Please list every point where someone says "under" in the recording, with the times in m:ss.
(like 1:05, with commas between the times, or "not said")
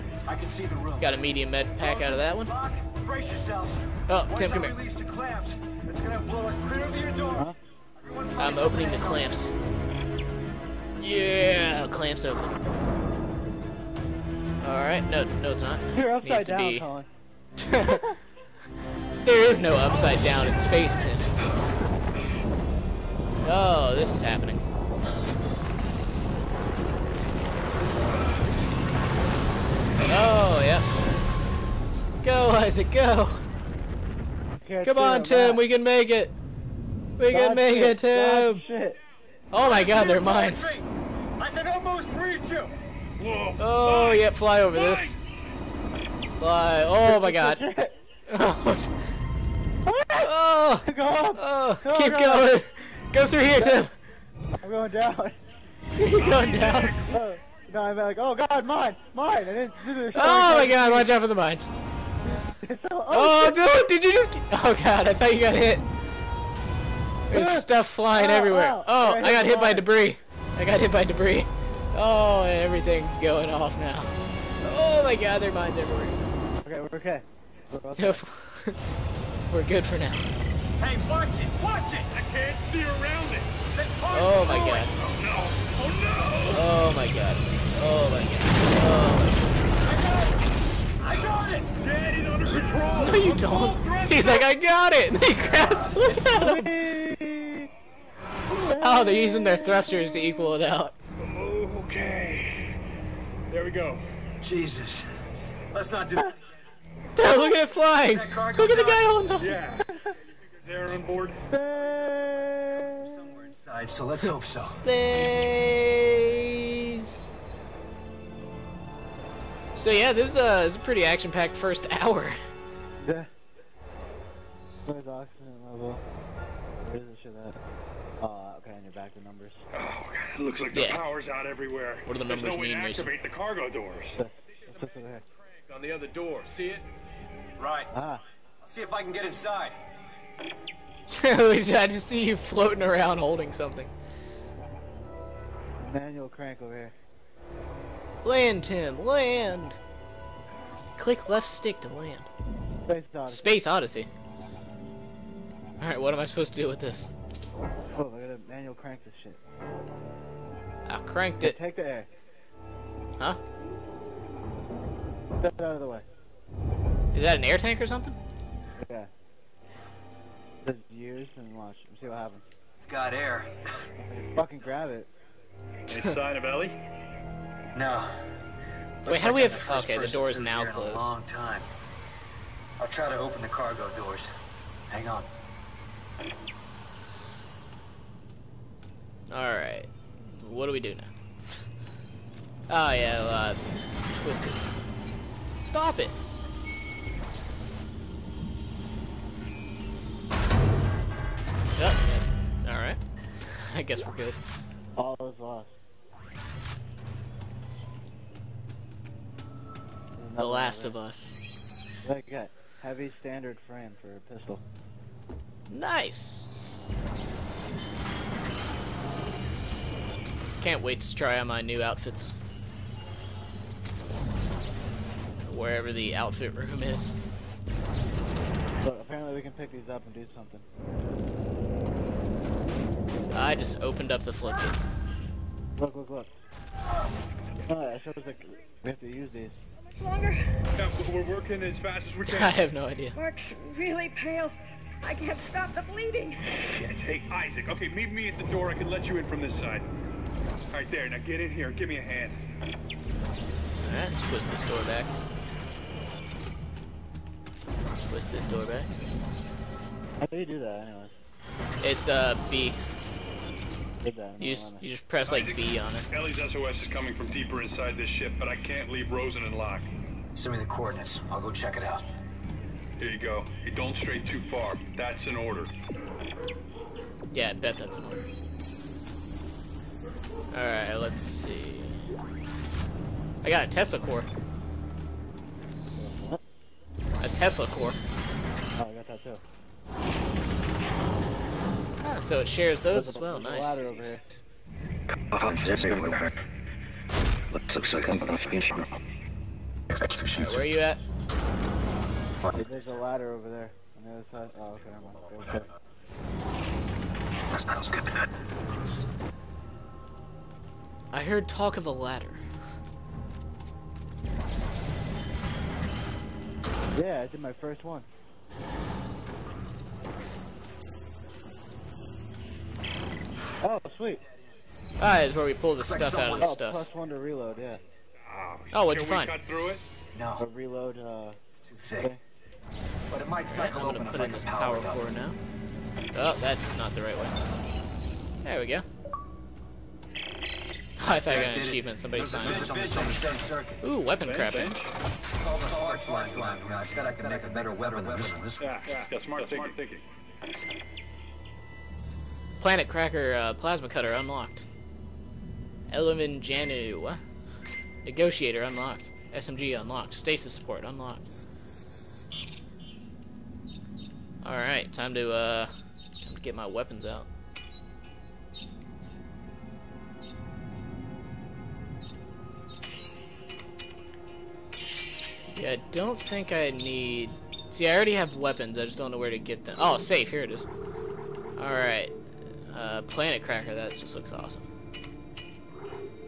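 1:32.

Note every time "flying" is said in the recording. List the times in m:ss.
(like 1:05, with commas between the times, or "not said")
1:07, 1:47.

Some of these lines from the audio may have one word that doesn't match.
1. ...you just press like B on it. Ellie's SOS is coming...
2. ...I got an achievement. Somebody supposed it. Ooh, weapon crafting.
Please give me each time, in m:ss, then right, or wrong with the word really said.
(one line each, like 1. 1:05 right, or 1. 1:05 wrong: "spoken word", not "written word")
1. 4:24 right
2. 5:41 wrong: "signed", not "supposed".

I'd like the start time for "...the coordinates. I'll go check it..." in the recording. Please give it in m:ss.
4:30.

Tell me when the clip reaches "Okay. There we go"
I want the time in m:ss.
1:41.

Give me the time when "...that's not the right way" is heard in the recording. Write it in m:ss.
5:36.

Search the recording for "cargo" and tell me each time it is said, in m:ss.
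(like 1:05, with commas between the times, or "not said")
2:13, 3:03.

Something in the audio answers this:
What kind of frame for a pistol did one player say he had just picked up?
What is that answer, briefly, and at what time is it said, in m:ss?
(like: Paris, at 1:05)
Heavy standard frame, at 3:32.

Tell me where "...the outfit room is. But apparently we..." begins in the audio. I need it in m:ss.
3:45.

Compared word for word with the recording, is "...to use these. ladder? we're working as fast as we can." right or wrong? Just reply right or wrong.
wrong.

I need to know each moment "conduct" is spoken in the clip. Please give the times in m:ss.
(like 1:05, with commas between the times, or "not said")
not said.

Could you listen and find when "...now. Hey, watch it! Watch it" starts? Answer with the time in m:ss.
1:19.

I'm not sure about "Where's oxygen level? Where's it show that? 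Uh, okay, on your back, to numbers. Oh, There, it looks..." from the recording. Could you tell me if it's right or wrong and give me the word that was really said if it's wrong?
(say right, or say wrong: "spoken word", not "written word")
wrong: "God", not "There".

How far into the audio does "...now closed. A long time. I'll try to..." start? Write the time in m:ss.
3:00.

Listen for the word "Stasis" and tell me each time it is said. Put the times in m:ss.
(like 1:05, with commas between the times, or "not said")
6:00.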